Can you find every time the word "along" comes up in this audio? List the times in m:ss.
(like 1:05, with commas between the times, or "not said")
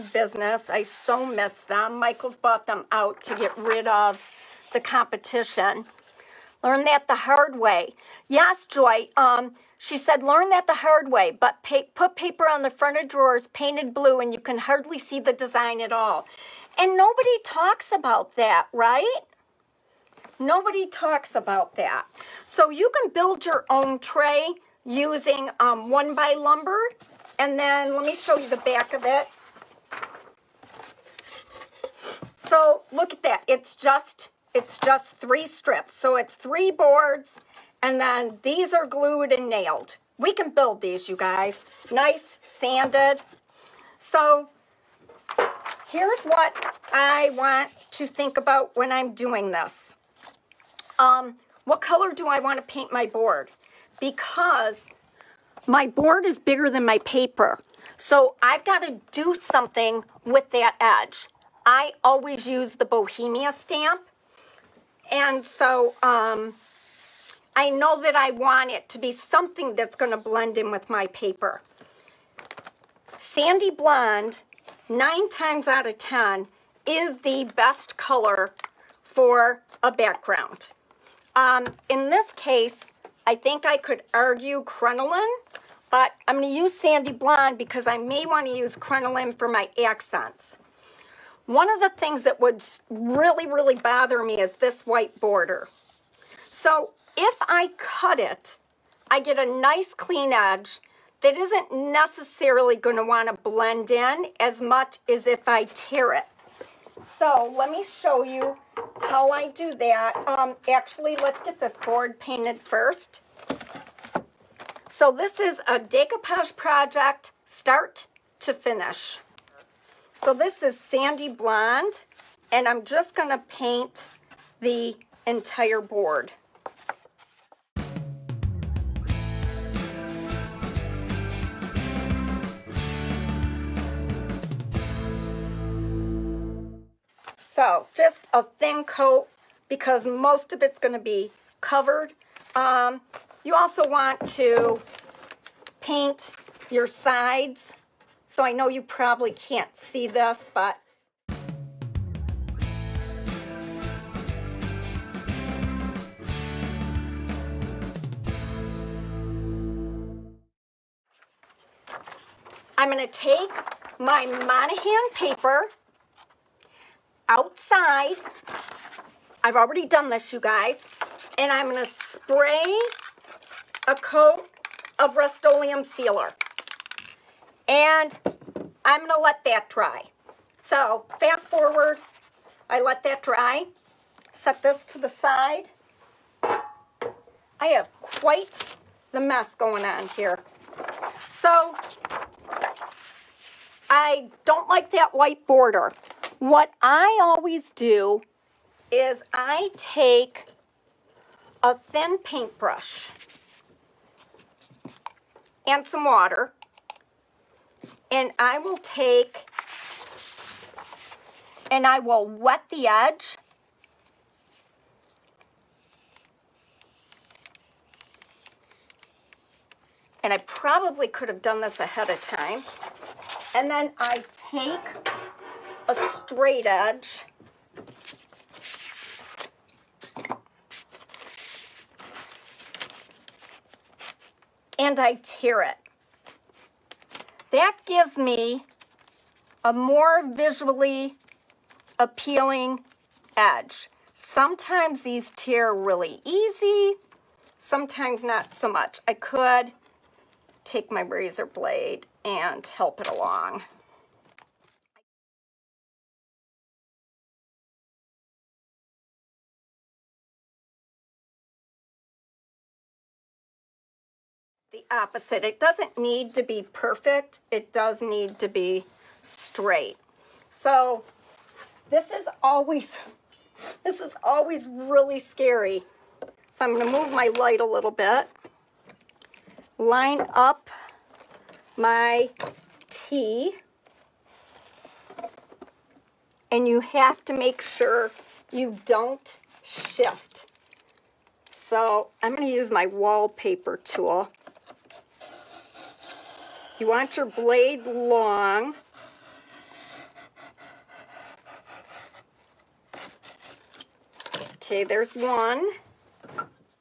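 4:13.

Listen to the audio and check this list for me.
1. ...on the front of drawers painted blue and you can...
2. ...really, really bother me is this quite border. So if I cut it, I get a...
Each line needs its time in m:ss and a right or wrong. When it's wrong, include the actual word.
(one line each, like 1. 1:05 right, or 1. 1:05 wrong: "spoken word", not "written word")
1. 0:12 right
2. 1:32 wrong: "white", not "quite".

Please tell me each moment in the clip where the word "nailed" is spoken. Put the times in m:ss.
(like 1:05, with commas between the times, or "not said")
0:39.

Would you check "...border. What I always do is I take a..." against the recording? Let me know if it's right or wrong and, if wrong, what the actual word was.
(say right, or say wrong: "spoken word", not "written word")
right.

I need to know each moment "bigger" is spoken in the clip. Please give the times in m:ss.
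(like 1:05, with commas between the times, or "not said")
0:56.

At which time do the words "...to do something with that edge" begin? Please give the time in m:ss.
0:58.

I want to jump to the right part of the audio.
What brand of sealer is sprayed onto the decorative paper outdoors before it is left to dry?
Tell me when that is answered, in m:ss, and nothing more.
2:55.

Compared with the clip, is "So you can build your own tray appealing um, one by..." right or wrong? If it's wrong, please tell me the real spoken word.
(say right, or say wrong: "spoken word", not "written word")
wrong: "using", not "appealing".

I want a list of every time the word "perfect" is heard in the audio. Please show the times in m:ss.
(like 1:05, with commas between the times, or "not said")
4:26.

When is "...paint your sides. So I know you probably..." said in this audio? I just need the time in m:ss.
2:25.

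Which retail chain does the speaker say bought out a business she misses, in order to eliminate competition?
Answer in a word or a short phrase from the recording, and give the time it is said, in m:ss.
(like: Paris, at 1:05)
Michael's, at 0:01.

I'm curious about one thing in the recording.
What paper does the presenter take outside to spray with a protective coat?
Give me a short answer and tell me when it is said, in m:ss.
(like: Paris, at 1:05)
Monahan, at 2:44.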